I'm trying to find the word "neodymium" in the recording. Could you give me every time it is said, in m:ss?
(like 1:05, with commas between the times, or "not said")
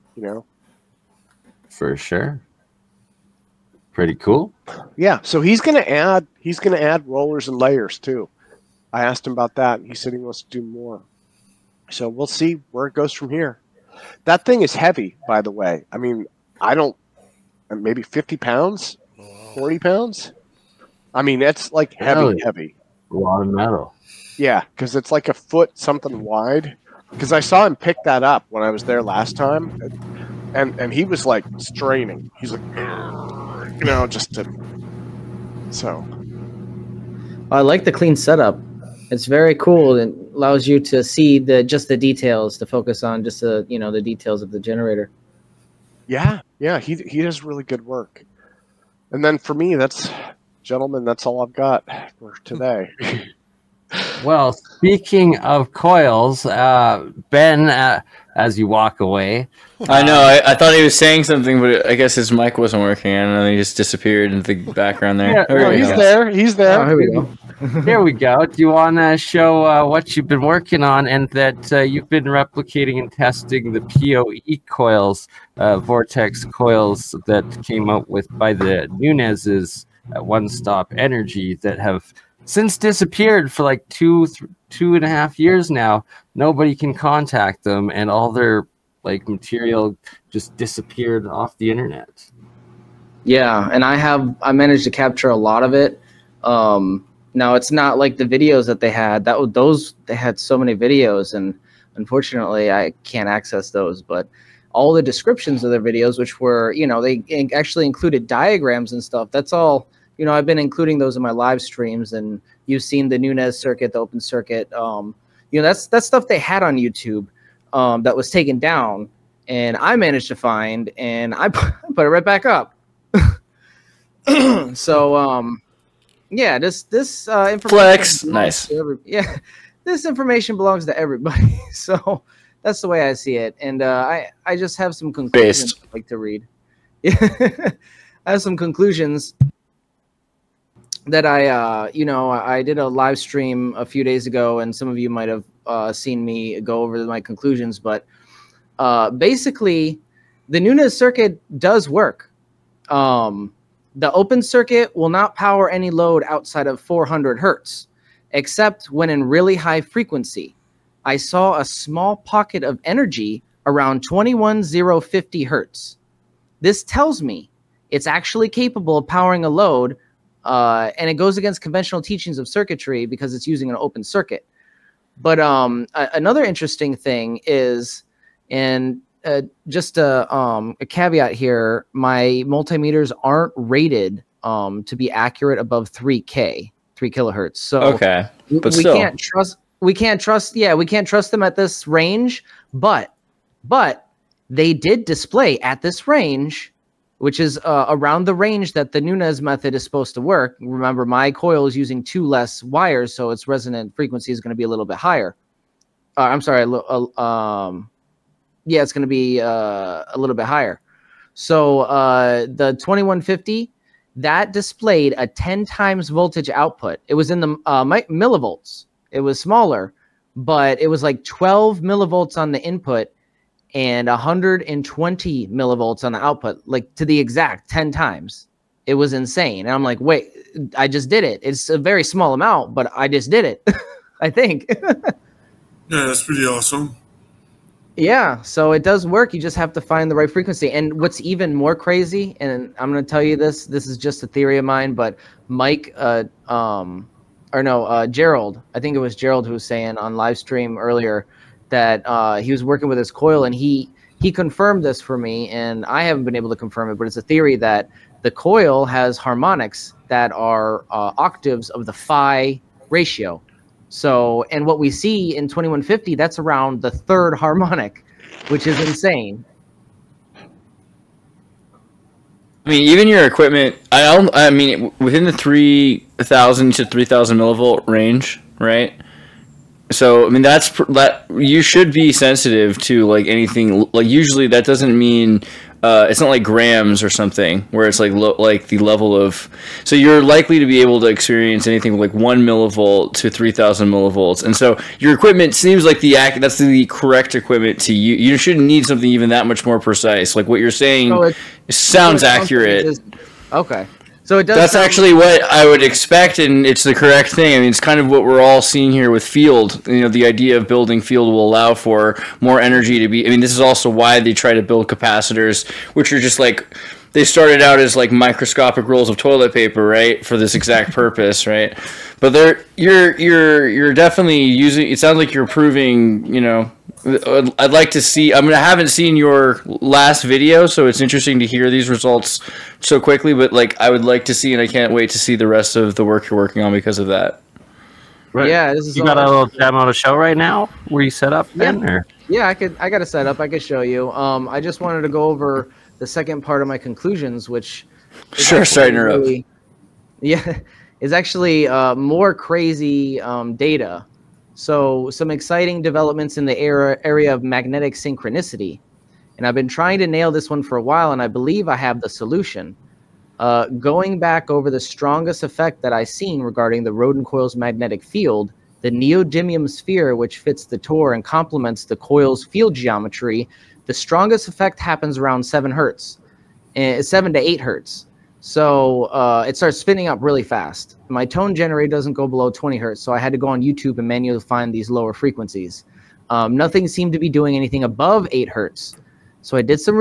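6:08.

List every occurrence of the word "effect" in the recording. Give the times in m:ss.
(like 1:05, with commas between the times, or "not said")
6:05, 6:14.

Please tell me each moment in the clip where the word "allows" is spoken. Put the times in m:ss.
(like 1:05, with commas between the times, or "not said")
0:40, 5:11.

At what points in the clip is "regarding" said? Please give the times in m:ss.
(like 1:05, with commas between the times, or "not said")
6:06.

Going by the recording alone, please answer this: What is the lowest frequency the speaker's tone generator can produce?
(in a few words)
20 hertz.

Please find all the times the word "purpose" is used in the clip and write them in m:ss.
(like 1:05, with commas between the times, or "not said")
5:20.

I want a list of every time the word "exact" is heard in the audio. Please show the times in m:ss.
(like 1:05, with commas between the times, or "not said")
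3:47, 5:20.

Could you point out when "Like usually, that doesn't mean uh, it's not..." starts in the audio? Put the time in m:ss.
4:43.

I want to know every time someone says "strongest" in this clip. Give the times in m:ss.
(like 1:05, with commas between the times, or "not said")
6:04, 6:13.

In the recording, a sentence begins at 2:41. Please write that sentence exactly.
I saw a small pocket of energy around 21050 hertz.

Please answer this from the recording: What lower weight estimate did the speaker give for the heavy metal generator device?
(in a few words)
40 pounds.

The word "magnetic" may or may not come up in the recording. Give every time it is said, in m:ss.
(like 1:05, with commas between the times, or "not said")
5:57, 6:07.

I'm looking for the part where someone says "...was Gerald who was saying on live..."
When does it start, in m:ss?
4:08.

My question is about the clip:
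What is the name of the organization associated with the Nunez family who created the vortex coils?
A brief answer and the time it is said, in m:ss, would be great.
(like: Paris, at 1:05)
One Stop Energy, at 1:20.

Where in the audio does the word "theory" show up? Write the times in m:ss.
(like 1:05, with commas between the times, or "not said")
4:04, 4:17.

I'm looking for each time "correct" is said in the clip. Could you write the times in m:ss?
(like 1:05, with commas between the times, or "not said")
4:56, 5:06.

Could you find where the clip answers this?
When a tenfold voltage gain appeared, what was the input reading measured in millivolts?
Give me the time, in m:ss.
3:41.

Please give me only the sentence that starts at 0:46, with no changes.
Yeah, yeah, he he does really good work.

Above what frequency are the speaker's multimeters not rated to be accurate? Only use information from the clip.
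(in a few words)
3 kilohertz.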